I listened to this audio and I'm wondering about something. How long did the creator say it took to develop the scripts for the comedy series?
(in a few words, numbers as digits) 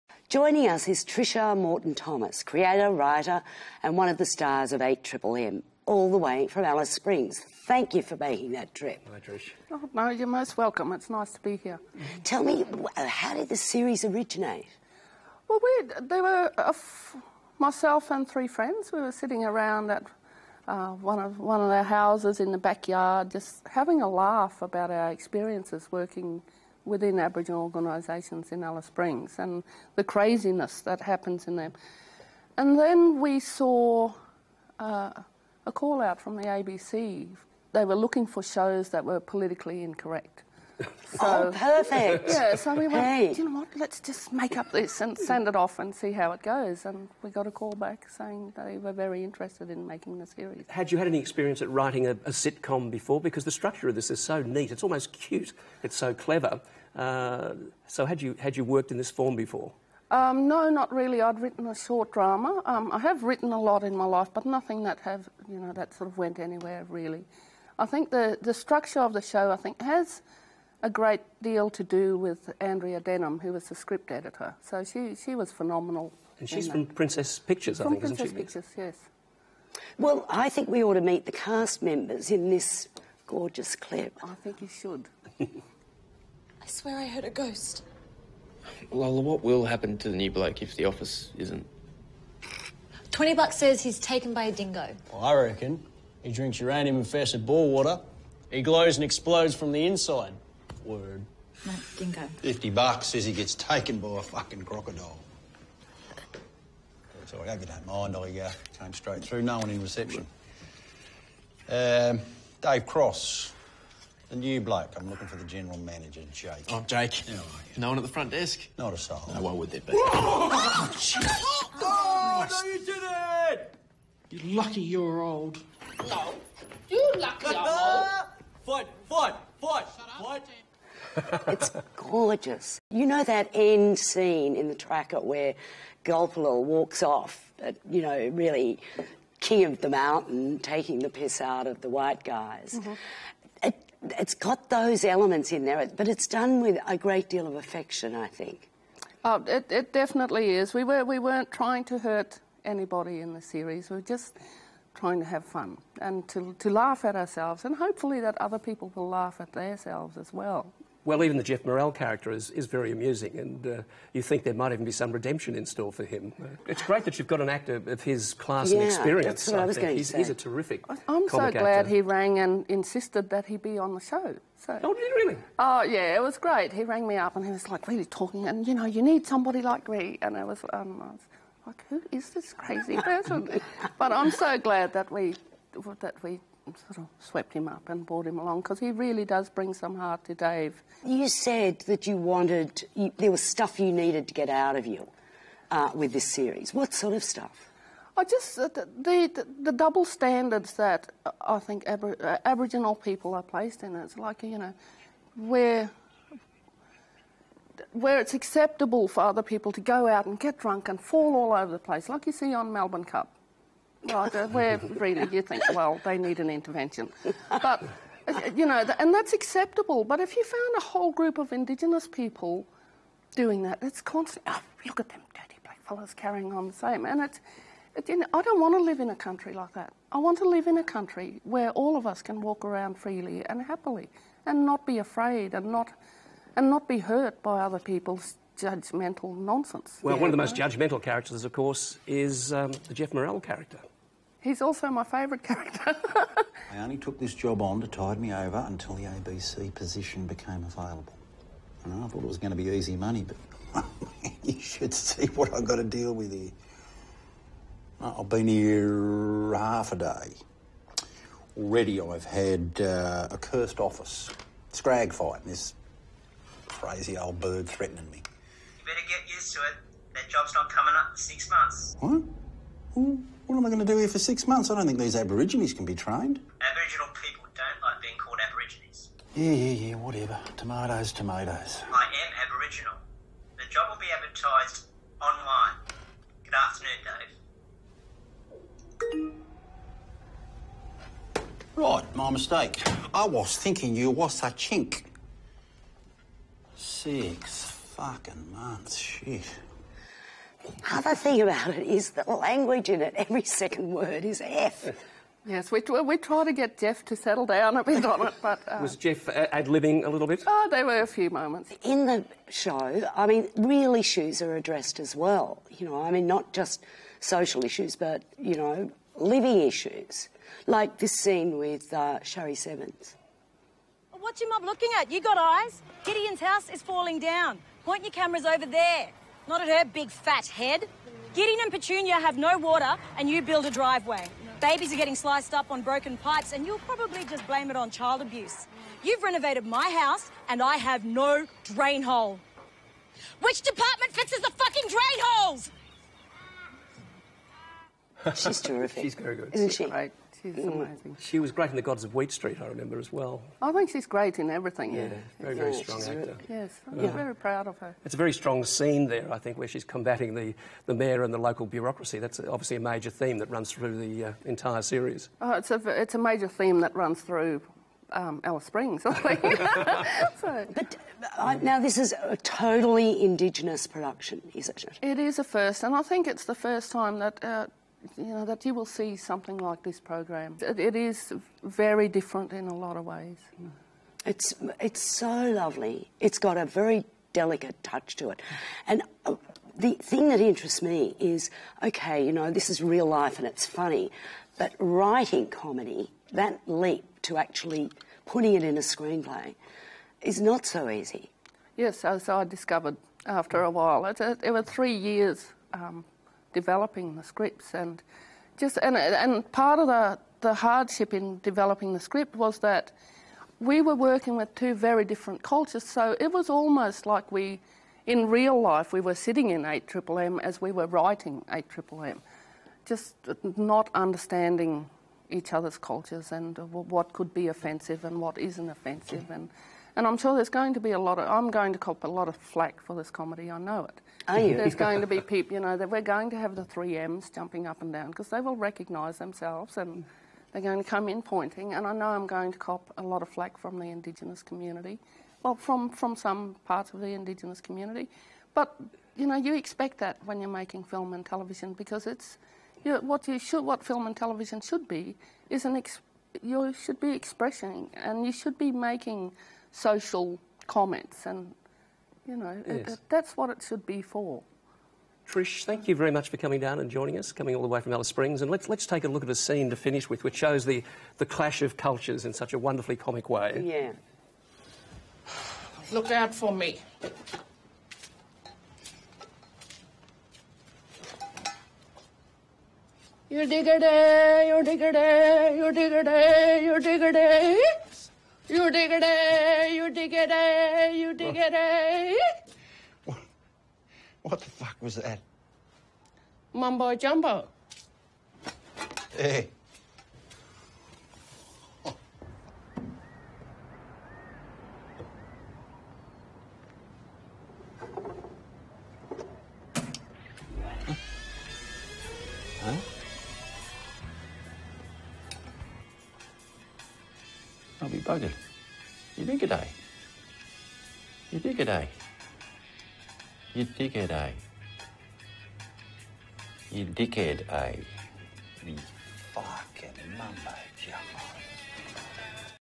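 3 years.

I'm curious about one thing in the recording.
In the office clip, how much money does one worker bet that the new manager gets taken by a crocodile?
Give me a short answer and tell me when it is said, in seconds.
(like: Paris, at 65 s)
50 bucks, at 102 s.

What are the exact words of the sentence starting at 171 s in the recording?
he rang and insisted that he be on the show.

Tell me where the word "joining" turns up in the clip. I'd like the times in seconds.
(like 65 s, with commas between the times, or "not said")
0 s, 466 s.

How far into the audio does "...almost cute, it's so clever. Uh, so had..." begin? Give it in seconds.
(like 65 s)
54 s.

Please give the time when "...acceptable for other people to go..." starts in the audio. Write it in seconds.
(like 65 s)
208 s.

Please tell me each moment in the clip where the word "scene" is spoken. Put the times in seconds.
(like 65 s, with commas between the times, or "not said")
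133 s, 321 s, 358 s, 469 s.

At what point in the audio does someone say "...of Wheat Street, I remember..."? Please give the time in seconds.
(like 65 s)
352 s.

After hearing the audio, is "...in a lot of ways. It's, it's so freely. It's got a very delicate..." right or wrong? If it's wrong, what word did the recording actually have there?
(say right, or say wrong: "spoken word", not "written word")
wrong: "lovely", not "freely".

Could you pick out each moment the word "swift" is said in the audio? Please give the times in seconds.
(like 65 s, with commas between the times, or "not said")
not said.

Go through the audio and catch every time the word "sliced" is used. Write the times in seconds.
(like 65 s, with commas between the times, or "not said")
335 s.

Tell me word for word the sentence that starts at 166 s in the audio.
It's great that you've got an actor of his class yeah, and experience.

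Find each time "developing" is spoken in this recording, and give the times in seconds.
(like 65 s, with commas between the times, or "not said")
406 s, 411 s.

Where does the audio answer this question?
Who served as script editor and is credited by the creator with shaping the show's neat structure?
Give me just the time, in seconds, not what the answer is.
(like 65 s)
72 s.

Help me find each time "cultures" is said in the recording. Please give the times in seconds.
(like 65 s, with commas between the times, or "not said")
415 s, 425 s, 471 s.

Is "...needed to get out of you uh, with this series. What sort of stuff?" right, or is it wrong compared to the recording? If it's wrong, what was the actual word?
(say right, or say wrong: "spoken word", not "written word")
right.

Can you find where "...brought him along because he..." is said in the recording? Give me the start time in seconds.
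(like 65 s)
188 s.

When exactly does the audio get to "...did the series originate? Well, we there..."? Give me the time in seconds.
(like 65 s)
13 s.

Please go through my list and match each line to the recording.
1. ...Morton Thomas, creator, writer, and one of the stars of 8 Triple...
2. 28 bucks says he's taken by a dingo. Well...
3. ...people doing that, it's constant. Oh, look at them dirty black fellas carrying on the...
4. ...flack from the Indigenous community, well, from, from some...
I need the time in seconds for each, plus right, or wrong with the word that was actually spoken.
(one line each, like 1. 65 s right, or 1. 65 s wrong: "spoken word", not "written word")
1. 1 s right
2. 93 s wrong: "20", not "28"
3. 222 s right
4. 443 s right.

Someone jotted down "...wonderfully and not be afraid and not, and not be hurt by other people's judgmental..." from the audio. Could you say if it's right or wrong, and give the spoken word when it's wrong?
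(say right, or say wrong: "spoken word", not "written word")
wrong: "happily", not "wonderfully".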